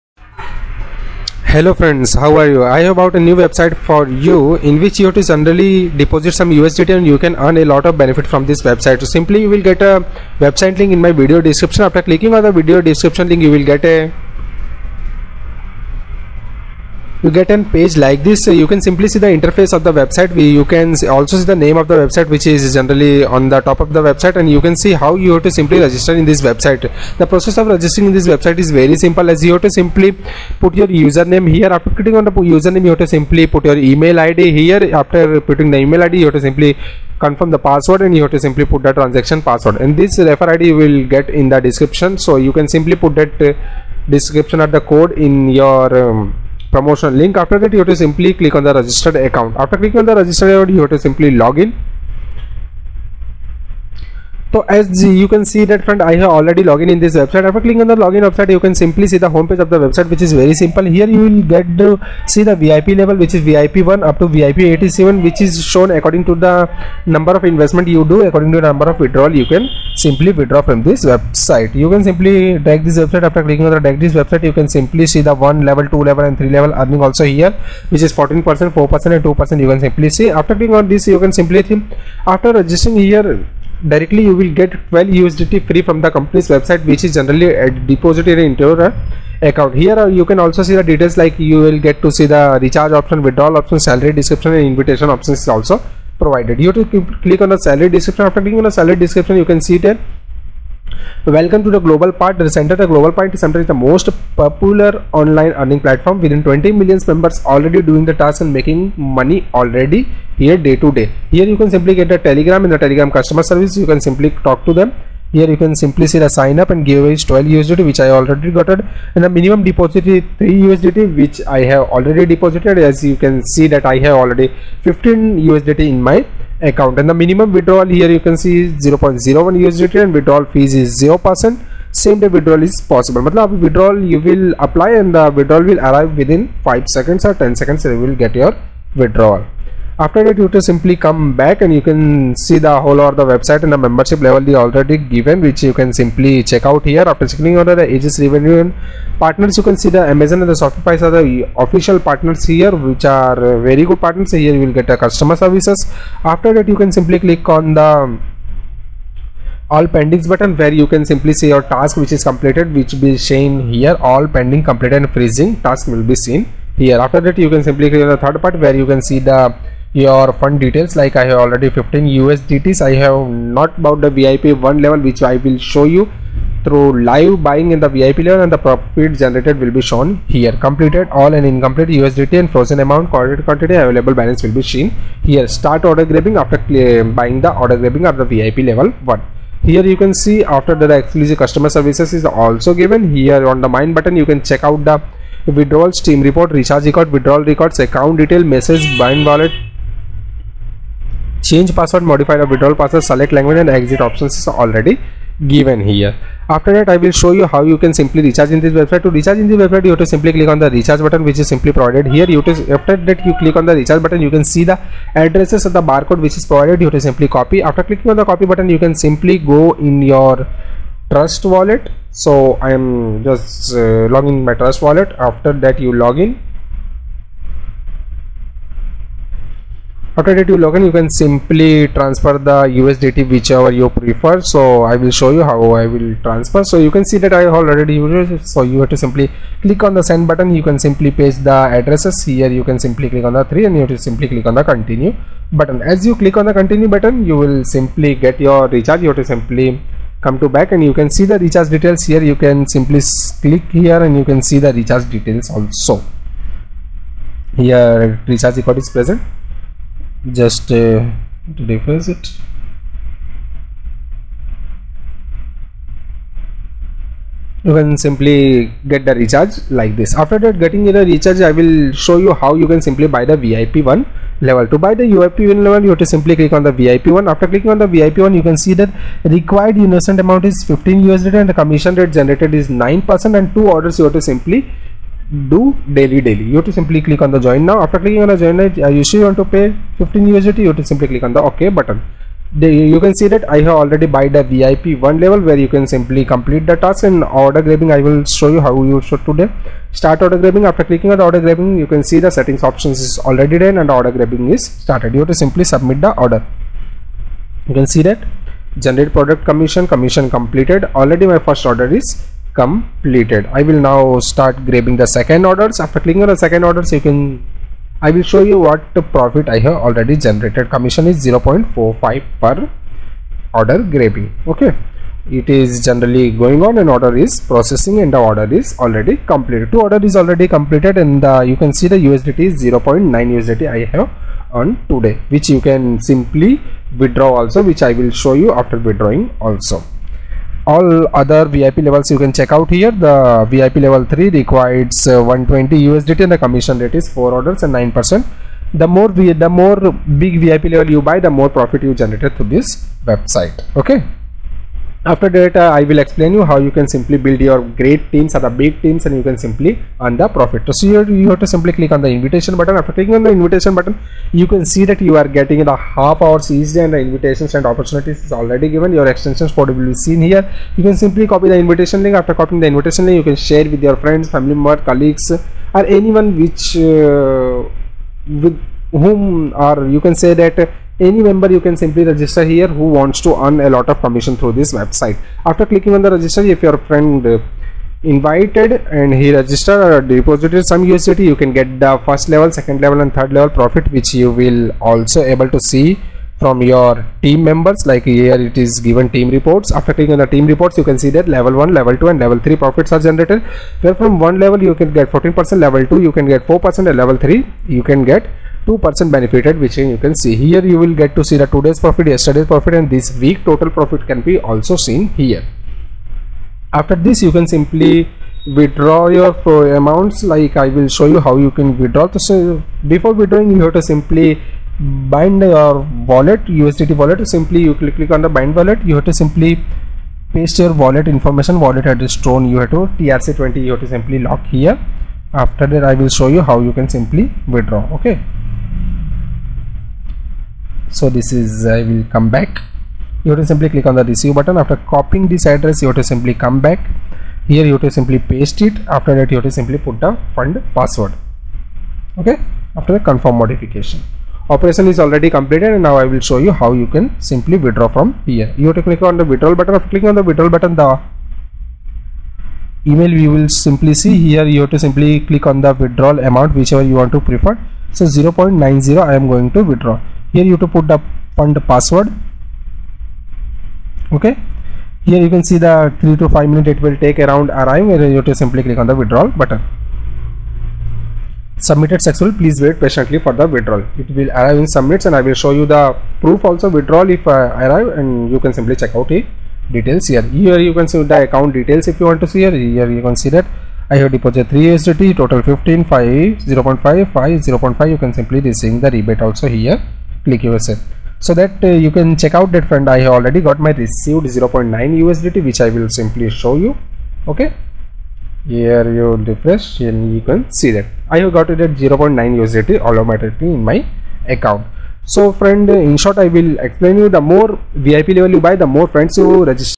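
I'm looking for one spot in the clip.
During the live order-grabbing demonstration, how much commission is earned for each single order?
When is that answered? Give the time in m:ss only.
5:21.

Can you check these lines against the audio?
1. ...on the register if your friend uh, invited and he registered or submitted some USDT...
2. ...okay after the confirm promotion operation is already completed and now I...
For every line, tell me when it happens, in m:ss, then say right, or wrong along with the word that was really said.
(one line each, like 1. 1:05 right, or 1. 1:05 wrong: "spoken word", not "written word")
1. 6:25 wrong: "deposited", not "submitted"
2. 7:32 wrong: "modification", not "promotion".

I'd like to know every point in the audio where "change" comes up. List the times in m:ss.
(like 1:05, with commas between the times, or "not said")
3:21.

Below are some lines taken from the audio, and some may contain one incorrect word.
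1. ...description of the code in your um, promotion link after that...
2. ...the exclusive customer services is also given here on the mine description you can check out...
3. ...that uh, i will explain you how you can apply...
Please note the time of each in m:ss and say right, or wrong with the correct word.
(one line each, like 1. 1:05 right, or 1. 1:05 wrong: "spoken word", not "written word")
1. 0:44 right
2. 3:10 wrong: "button", not "description"
3. 5:55 wrong: "simply", not "apply".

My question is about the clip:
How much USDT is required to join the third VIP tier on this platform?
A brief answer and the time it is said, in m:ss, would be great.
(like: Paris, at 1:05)
120 USDT, at 5:45.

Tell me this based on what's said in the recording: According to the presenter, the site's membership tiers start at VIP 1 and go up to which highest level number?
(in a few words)
VIP 87.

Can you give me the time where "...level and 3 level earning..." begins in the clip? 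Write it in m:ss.
1:16.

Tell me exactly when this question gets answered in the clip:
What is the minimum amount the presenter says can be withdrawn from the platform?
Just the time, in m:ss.
2:08.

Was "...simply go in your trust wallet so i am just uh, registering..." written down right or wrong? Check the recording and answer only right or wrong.
wrong.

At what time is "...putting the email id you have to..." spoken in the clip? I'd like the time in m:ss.
0:35.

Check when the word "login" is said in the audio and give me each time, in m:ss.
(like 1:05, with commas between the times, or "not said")
0:57, 3:50.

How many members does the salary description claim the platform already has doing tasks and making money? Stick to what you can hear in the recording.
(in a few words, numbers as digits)
20 million.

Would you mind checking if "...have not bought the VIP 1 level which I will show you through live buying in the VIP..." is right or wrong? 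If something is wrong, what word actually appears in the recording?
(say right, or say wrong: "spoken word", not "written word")
right.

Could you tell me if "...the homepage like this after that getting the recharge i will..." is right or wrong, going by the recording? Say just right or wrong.
wrong.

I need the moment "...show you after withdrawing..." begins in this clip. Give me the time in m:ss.
5:38.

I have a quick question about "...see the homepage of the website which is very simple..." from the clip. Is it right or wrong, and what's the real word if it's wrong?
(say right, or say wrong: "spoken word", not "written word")
right.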